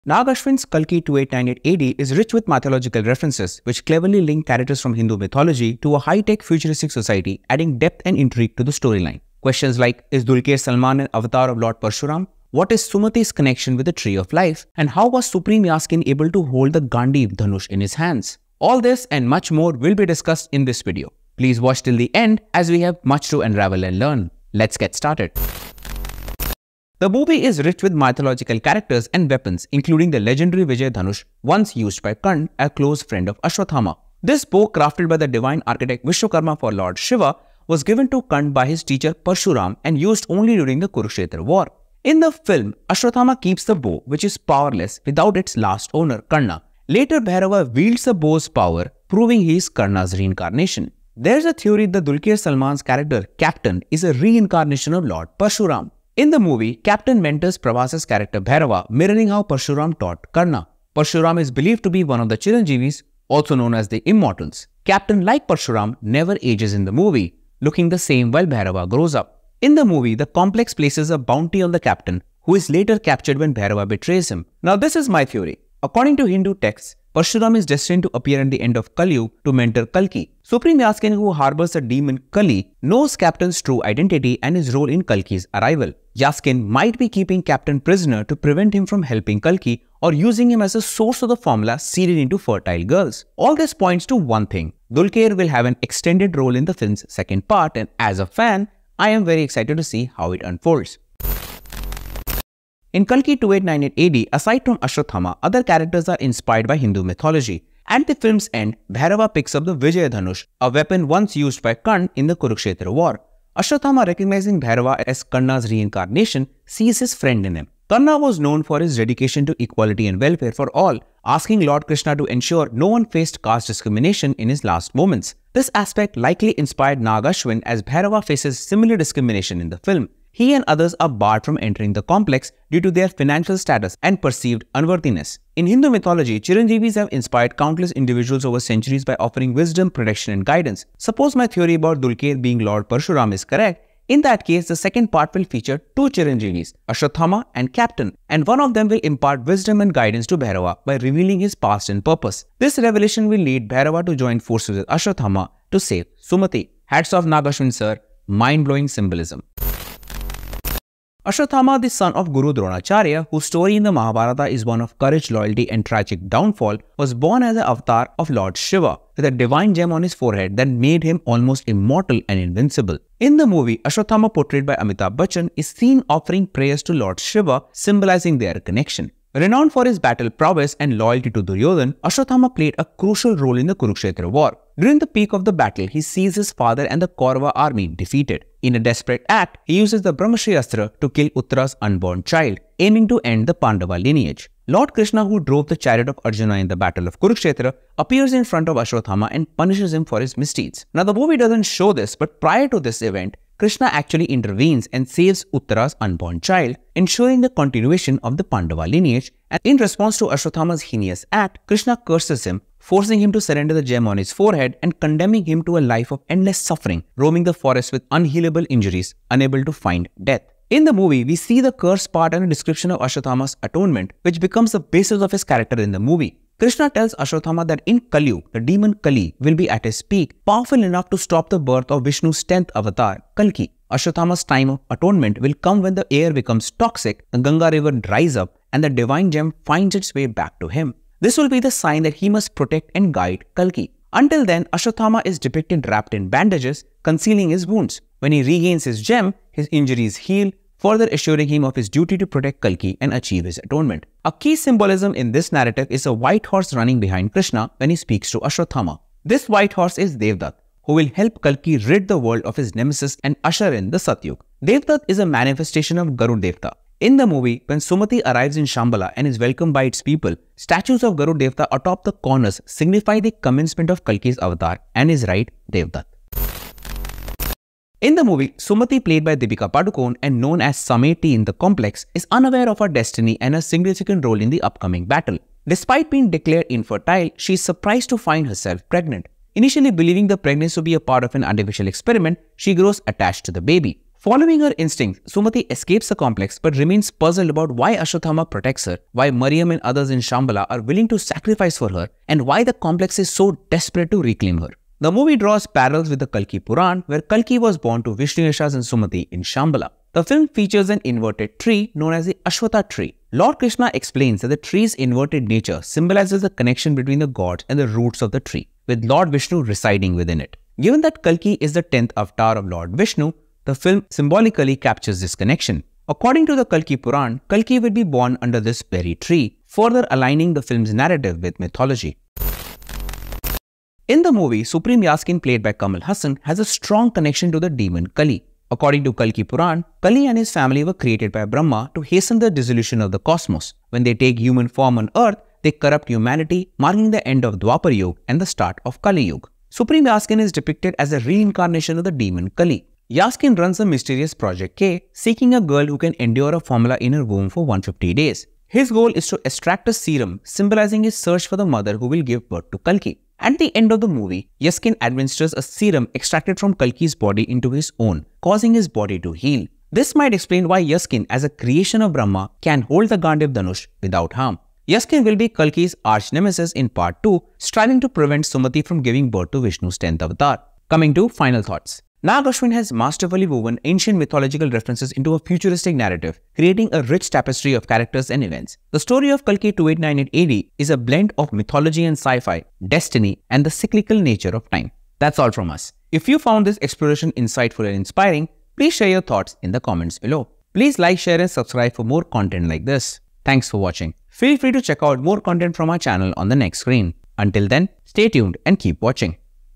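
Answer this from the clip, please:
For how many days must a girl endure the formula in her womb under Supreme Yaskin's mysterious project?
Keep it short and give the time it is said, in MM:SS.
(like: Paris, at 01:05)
150, at 05:57.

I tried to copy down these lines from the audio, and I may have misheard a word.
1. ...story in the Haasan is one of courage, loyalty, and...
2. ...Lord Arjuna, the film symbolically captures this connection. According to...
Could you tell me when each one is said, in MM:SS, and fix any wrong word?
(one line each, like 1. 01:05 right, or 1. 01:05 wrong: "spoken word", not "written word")
1. 02:43 wrong: "Mahabharata", not "Haasan"
2. 05:22 wrong: "Vishnu", not "Arjuna".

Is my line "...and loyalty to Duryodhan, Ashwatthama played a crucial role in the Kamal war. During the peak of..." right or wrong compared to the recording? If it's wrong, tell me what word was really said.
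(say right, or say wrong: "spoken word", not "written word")
wrong: "Kurukshetra", not "Kamal".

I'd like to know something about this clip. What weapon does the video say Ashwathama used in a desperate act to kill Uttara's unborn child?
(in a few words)
Brahmashirastra.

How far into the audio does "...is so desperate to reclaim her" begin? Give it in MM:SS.
05:03.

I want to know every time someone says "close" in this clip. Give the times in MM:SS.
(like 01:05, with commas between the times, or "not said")
00:32.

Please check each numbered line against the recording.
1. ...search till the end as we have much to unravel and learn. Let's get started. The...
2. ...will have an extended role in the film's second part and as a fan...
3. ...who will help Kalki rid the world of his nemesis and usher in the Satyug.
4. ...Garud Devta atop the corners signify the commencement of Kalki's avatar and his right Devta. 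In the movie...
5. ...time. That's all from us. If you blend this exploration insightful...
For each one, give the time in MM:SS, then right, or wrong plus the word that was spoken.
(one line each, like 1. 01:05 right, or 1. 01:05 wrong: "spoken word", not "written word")
1. 00:21 wrong: "watch", not "search"
2. 01:35 right
3. 04:20 right
4. 04:31 right
5. 06:34 wrong: "found", not "blend".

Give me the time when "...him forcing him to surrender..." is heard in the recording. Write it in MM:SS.
03:32.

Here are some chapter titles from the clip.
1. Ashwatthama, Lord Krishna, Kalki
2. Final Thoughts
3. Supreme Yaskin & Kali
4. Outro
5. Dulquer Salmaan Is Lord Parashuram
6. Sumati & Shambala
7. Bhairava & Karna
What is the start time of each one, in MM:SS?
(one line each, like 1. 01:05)
1. 02:40
2. 06:17
3. 05:32
4. 06:36
5. 00:25
6. 04:36
7. 01:42.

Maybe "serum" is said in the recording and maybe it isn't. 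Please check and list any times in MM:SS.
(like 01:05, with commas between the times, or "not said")
05:59, 06:05.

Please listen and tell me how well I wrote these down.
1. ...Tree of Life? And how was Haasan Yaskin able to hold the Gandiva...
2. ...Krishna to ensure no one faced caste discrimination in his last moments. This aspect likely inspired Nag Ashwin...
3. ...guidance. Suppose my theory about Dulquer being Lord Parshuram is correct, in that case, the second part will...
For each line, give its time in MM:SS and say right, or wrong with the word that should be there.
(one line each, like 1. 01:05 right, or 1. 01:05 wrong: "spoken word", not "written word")
1. 00:13 wrong: "Supreme", not "Haasan"
2. 02:01 right
3. 02:20 right.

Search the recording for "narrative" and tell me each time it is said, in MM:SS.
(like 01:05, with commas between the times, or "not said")
04:15, 05:30, 06:25.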